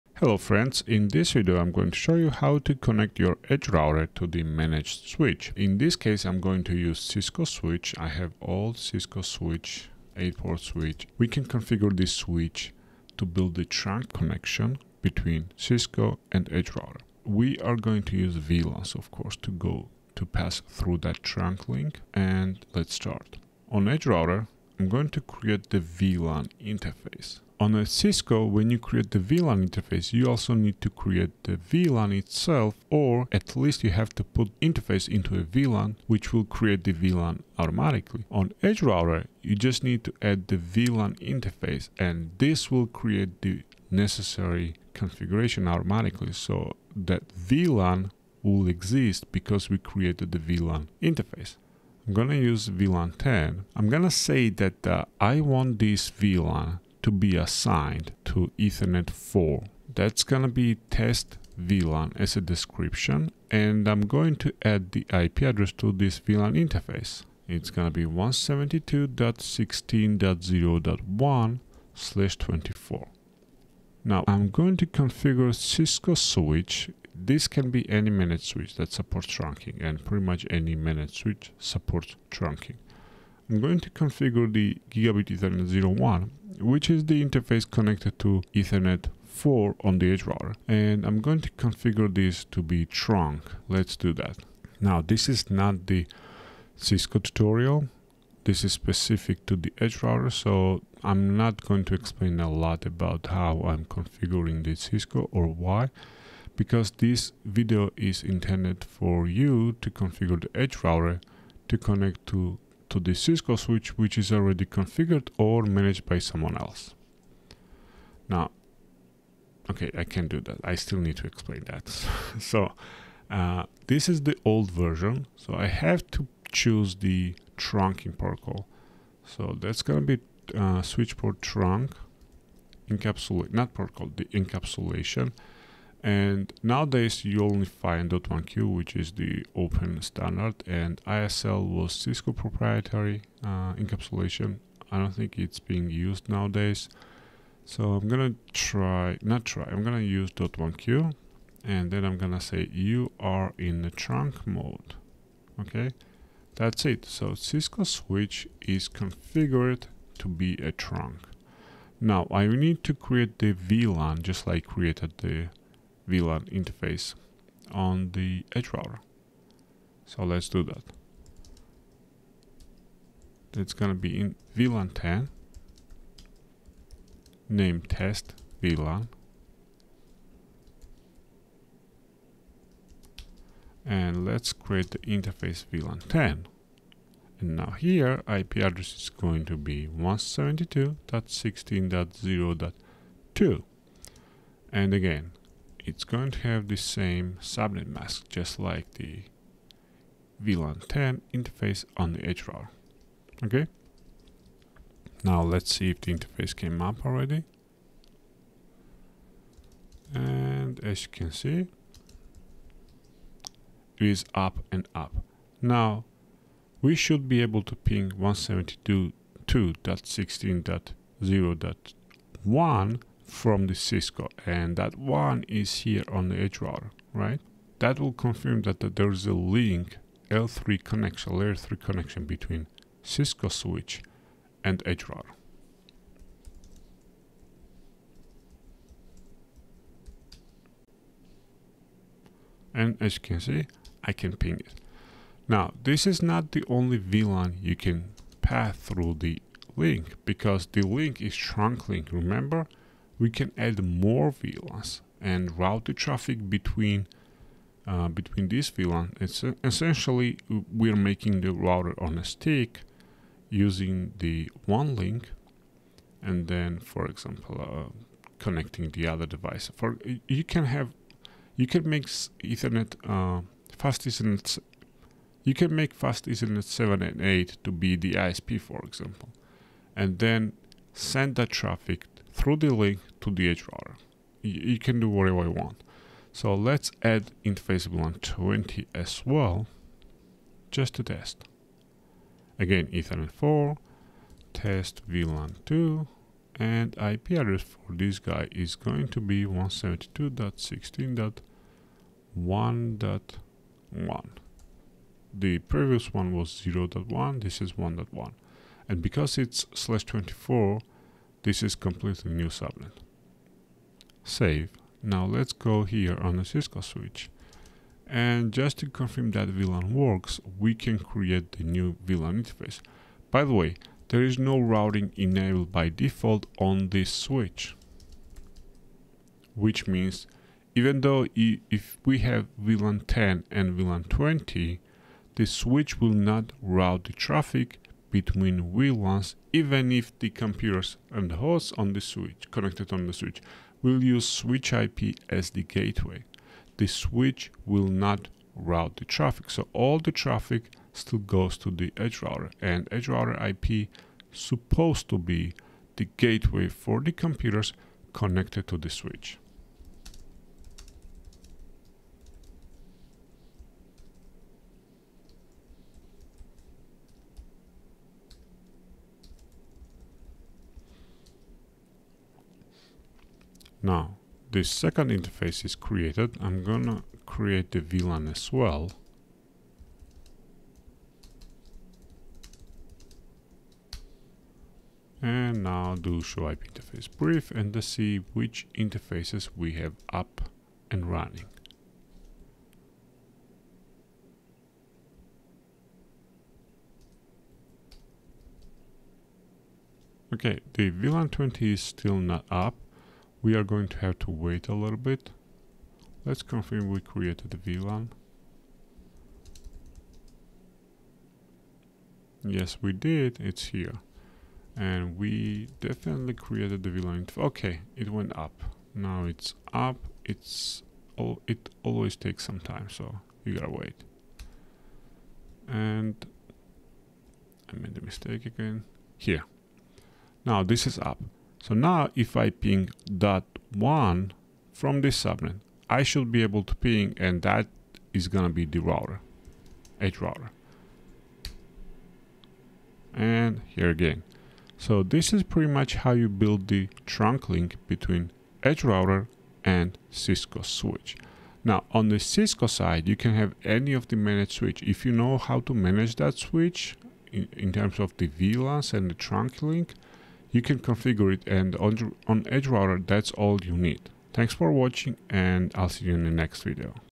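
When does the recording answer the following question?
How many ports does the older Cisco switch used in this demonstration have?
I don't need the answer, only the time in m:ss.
0:10.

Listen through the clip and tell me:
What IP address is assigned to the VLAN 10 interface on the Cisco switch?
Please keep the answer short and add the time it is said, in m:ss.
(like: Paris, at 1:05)
172.16.0.2, at 3:09.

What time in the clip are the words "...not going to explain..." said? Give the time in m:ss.
1:41.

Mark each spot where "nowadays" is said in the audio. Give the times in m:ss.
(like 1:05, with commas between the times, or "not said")
2:16, 2:26.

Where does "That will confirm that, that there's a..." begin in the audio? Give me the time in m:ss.
3:47.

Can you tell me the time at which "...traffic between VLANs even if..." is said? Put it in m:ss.
5:37.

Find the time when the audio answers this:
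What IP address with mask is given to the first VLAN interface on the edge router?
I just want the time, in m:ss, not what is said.
1:08.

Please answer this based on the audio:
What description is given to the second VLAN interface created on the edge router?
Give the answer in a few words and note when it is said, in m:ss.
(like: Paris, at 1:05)
test VLAN 2, at 4:54.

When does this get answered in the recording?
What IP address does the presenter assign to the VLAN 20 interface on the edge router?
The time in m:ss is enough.
4:59.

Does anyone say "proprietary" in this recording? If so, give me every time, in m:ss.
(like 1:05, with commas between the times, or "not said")
2:22.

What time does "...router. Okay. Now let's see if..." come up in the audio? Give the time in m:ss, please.
3:22.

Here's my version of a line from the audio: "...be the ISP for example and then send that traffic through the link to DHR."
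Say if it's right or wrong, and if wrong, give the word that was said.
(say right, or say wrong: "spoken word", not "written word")
right.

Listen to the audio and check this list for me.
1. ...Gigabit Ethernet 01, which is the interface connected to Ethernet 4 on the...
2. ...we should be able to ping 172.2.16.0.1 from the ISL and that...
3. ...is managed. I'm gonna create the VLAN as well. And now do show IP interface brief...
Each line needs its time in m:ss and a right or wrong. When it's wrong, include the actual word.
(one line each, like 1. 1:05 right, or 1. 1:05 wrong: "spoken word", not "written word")
1. 1:24 right
2. 3:36 wrong: "Cisco", not "ISL"
3. 6:15 wrong: "created", not "managed".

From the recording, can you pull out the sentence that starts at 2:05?
So I have to choose the trunking protocol.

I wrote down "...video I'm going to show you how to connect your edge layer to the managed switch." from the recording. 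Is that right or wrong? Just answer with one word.
wrong.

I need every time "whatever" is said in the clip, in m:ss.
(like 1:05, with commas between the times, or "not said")
4:45.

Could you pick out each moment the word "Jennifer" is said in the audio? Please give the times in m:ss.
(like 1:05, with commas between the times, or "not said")
not said.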